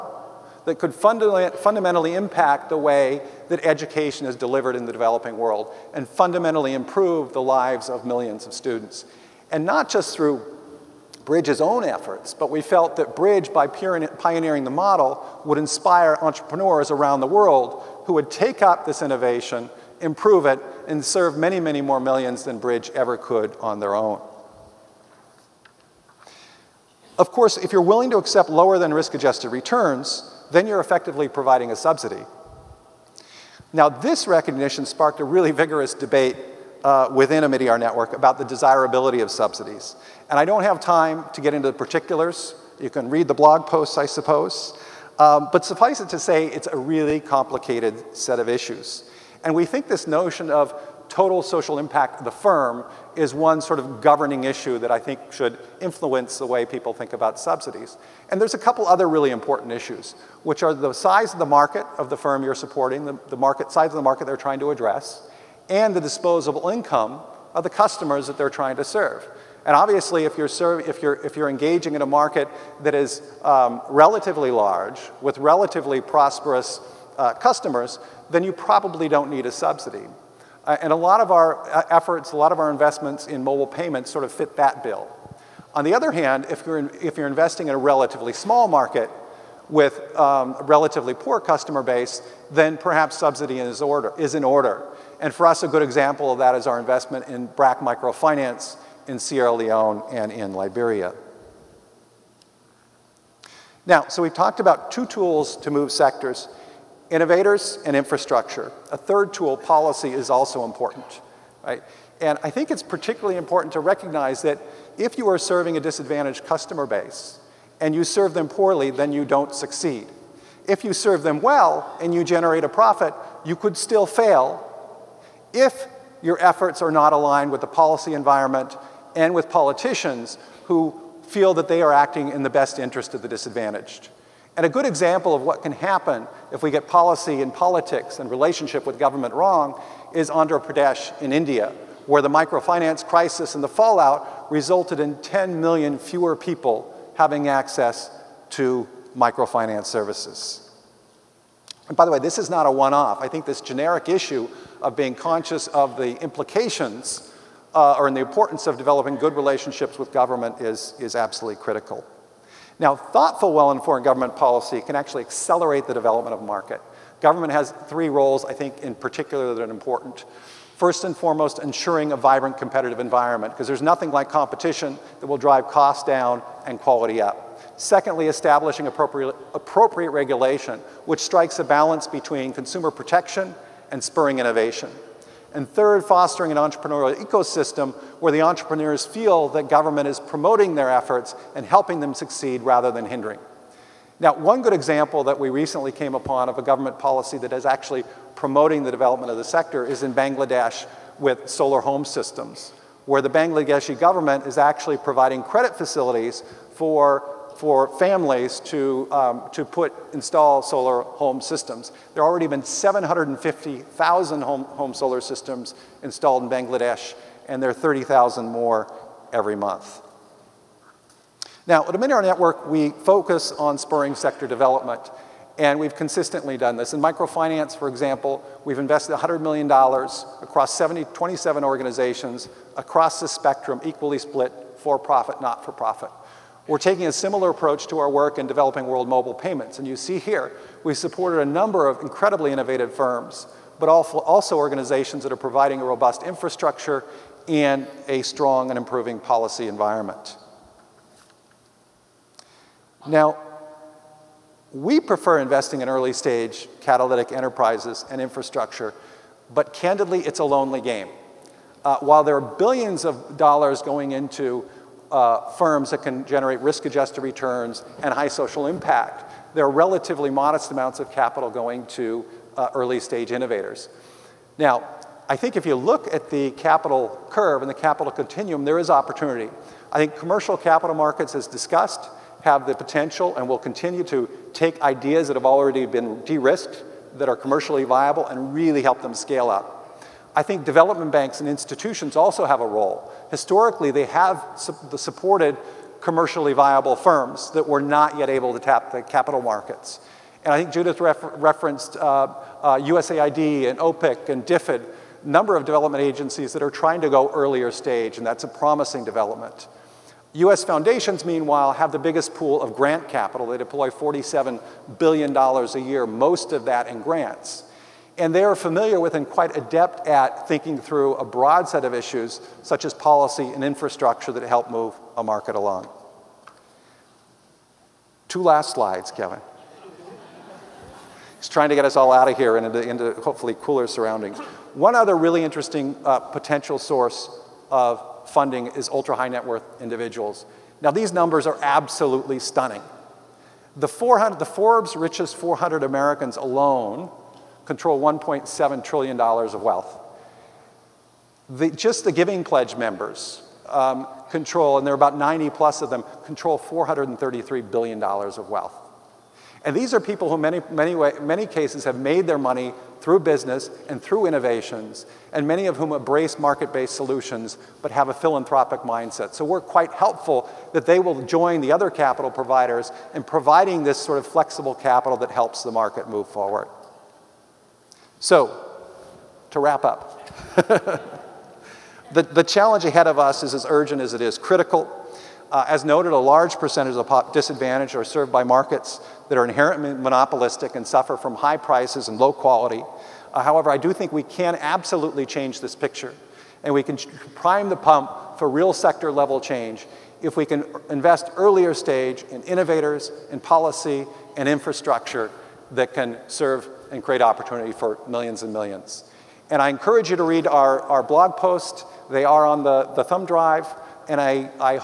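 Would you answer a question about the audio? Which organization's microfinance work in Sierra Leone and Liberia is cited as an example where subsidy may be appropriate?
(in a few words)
BRAC.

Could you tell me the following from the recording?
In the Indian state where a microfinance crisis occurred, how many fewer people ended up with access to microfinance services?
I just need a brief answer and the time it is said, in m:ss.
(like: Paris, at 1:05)
10 million, at 2:25.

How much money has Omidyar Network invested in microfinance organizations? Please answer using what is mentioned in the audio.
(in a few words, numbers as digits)
$100 million.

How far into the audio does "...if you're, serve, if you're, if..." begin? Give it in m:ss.
1:10.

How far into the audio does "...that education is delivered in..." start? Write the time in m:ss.
0:03.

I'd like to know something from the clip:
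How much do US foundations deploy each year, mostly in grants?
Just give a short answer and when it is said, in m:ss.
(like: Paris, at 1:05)
$47 billion, at 5:13.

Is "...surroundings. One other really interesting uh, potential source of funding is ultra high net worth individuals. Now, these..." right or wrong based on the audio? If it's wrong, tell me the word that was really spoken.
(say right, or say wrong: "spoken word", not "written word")
right.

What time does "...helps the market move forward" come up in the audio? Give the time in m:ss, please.
6:15.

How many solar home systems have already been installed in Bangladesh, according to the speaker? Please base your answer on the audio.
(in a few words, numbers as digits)
750,000.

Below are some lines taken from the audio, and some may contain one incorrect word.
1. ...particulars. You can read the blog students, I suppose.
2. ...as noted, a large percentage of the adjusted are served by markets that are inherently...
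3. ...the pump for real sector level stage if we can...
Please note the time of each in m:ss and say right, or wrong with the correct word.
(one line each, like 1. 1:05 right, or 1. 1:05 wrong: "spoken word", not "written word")
1. 0:41 wrong: "posts", not "students"
2. 6:25 wrong: "disadvantaged", not "adjusted"
3. 6:37 wrong: "change", not "stage".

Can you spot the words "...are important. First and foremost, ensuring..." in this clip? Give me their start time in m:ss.
2:49.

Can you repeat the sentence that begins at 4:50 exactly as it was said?
I think development banks and institutions also have a role.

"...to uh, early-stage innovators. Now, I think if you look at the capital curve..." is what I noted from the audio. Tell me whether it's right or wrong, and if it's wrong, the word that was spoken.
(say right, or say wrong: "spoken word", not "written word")
right.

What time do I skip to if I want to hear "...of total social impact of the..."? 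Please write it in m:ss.
0:50.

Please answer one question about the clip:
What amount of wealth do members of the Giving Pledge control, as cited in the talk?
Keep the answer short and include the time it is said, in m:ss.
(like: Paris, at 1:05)
$433 billion, at 5:56.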